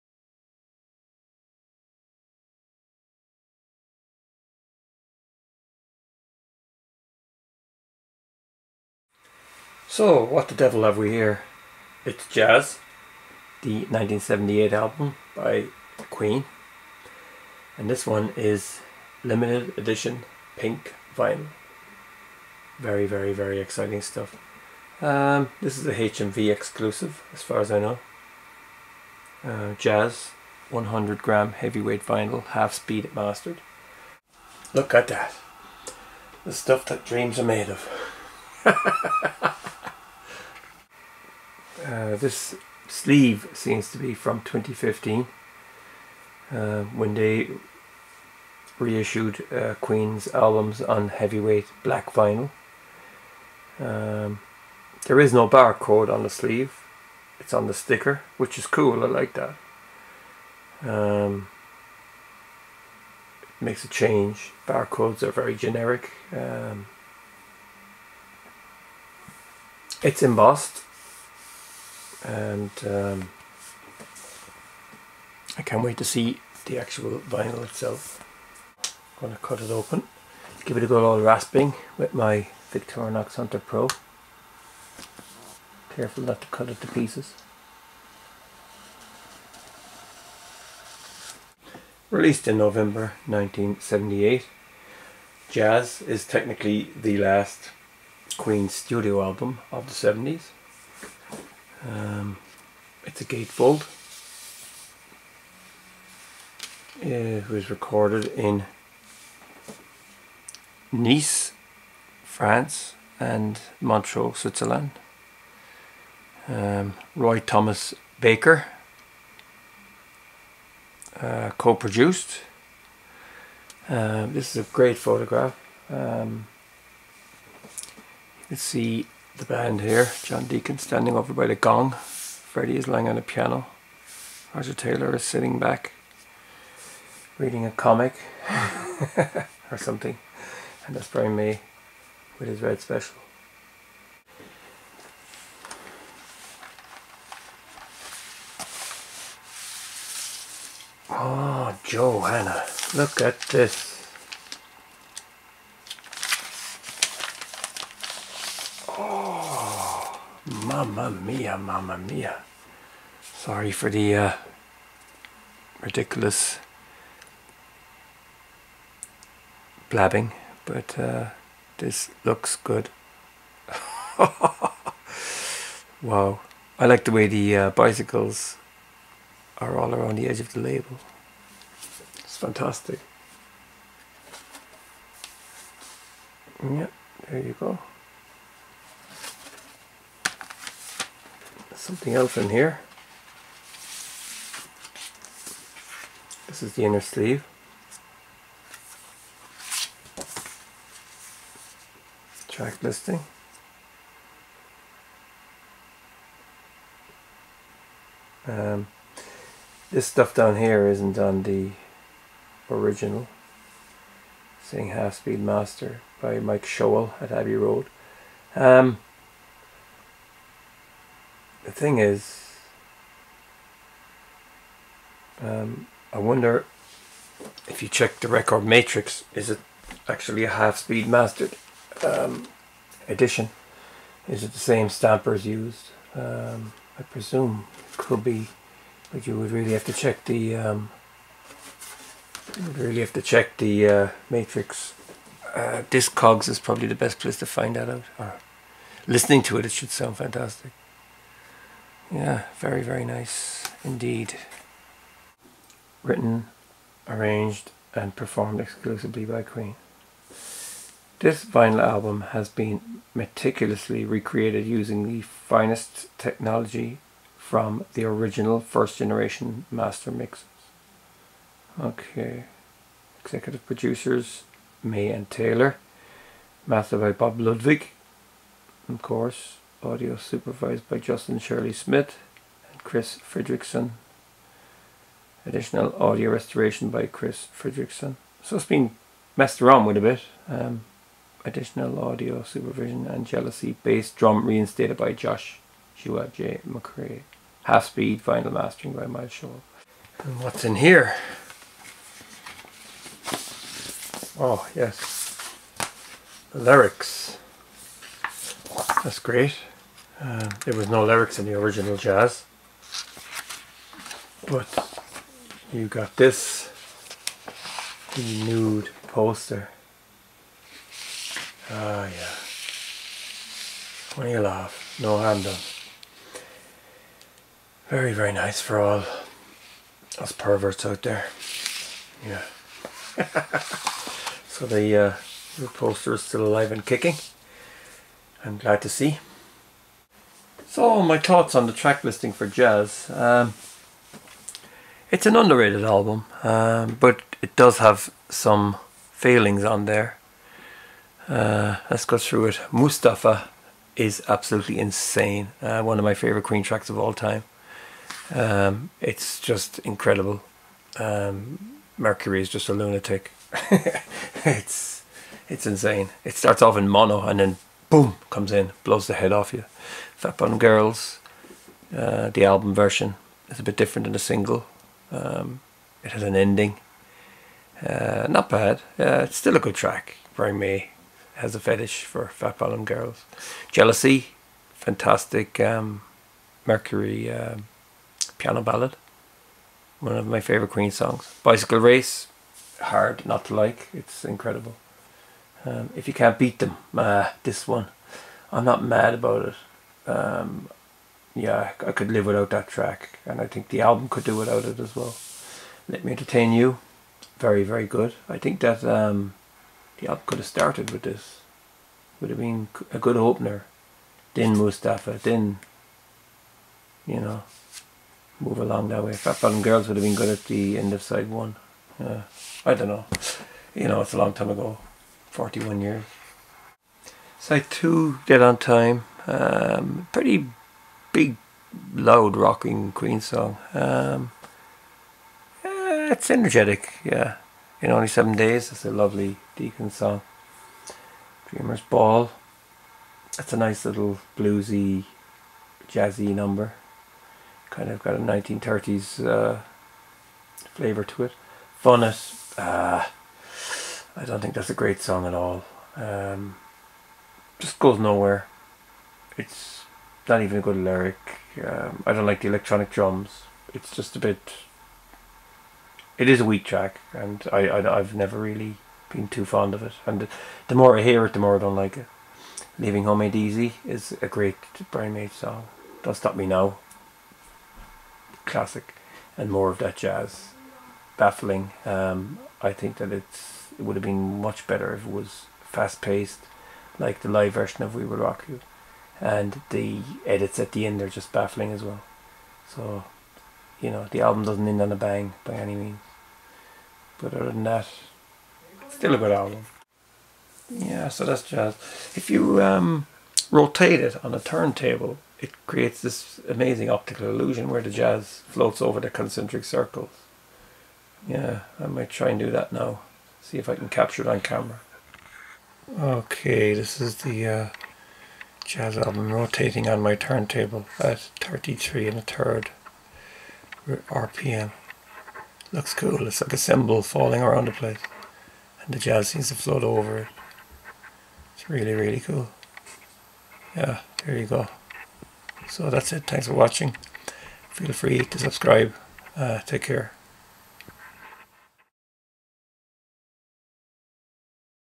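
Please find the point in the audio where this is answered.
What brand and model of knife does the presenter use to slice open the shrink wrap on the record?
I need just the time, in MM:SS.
01:22.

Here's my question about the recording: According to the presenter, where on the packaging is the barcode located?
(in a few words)
On the sticker.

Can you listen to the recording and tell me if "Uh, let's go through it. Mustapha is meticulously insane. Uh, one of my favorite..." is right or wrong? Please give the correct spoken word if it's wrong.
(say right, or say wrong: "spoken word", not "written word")
wrong: "absolutely", not "meticulously".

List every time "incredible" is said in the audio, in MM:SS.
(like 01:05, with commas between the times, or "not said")
05:59, 06:34.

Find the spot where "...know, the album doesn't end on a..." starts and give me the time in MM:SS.
08:13.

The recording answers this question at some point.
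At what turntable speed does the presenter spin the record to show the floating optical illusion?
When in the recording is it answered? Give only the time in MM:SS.
08:41.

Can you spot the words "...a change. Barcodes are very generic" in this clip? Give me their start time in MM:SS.
01:03.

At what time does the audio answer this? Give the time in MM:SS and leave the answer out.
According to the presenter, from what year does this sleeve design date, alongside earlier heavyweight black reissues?
00:44.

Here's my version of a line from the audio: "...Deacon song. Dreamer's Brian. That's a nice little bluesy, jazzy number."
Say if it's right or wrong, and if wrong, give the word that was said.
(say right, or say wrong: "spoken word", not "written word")
wrong: "Ball", not "Brian".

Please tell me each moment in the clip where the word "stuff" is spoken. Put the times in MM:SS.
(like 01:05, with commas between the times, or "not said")
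00:24, 00:36, 03:30.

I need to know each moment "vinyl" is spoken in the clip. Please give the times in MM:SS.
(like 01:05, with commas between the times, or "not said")
00:21, 00:32, 00:52, 01:17, 04:21, 04:58.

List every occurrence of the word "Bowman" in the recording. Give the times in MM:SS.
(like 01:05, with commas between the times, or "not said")
not said.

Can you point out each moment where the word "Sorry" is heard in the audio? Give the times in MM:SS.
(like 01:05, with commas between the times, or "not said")
02:43.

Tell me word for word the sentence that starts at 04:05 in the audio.
Uh, Discogs is probably the best place to find that out.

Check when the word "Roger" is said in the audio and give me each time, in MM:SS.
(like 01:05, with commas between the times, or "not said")
02:14.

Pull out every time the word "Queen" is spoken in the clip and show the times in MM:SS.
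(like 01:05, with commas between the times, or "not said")
00:16, 00:49, 01:38, 04:19, 05:56, 06:30, 07:12.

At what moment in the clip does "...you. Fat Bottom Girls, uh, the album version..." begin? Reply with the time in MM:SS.
06:09.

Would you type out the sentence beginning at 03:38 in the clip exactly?
Um, the thing is, um, I wonder if you check the record matrix, is it actually a half-speed mastered um, edition?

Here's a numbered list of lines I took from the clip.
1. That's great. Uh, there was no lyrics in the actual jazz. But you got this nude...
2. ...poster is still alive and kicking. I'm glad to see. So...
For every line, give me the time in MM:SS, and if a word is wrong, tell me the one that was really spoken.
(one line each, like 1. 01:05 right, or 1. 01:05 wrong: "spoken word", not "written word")
1. 05:09 wrong: "original", not "actual"
2. 05:35 right.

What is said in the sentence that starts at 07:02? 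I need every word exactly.
I don't know you know it's a long time ago 41 years.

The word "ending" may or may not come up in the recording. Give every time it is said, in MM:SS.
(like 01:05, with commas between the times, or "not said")
06:16.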